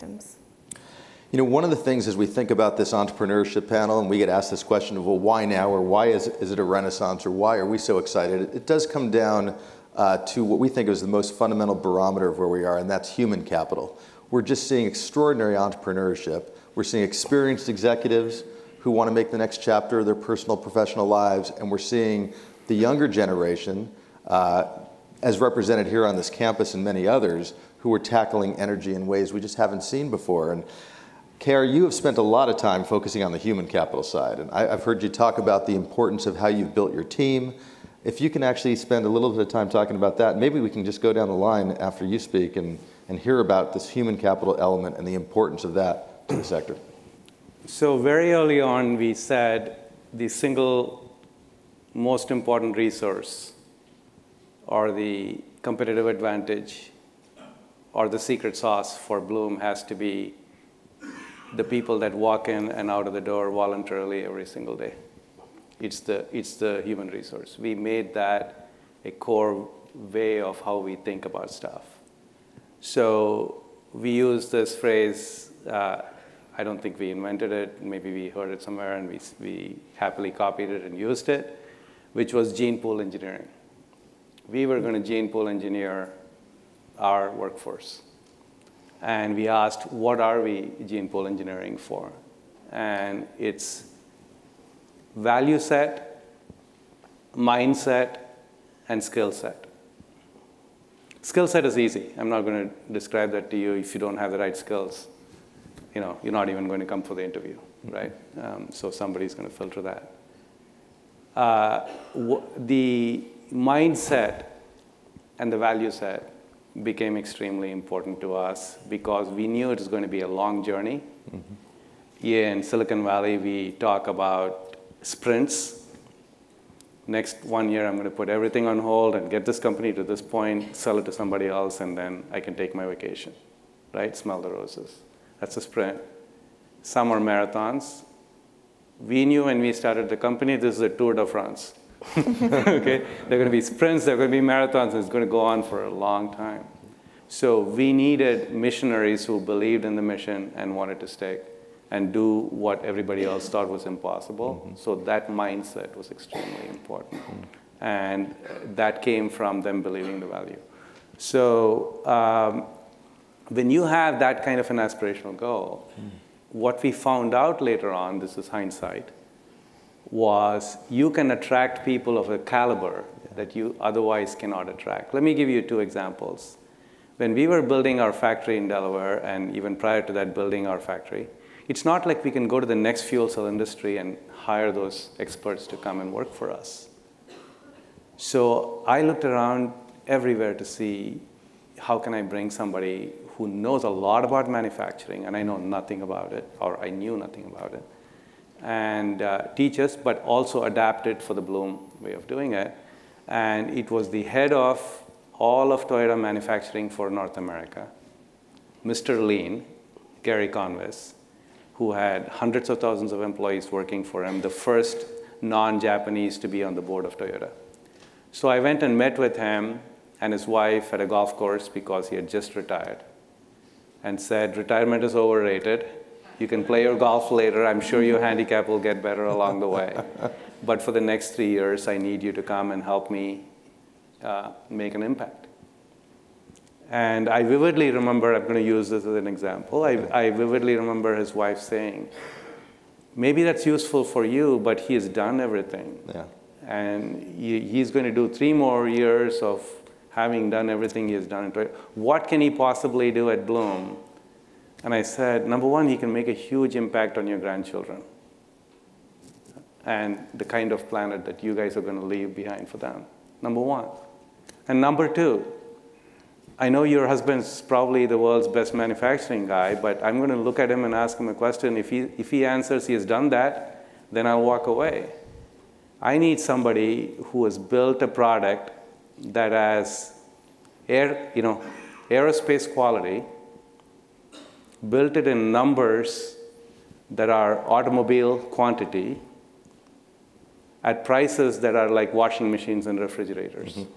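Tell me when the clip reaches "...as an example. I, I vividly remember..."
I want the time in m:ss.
3:59.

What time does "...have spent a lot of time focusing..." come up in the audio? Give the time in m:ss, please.
0:31.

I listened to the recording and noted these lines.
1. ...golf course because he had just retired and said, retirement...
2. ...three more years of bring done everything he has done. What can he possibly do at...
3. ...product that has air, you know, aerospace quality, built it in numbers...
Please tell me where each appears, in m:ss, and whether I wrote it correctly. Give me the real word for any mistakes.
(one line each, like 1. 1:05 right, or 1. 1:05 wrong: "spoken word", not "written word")
1. 3:41 right
2. 4:08 wrong: "having", not "bring"
3. 4:38 right.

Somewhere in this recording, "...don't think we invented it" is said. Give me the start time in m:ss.
1:16.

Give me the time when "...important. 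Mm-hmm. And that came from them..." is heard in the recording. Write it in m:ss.
2:36.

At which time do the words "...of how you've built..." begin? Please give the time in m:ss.
0:36.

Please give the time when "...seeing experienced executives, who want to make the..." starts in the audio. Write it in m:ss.
0:16.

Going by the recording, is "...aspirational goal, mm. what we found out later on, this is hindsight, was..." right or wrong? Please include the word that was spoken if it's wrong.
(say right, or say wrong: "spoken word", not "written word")
right.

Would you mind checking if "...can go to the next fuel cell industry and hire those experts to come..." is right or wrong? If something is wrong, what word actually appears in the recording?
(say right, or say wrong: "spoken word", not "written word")
right.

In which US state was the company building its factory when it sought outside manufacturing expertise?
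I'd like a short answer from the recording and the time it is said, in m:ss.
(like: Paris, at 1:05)
Delaware, at 2:58.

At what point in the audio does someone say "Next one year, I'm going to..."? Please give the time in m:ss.
2:07.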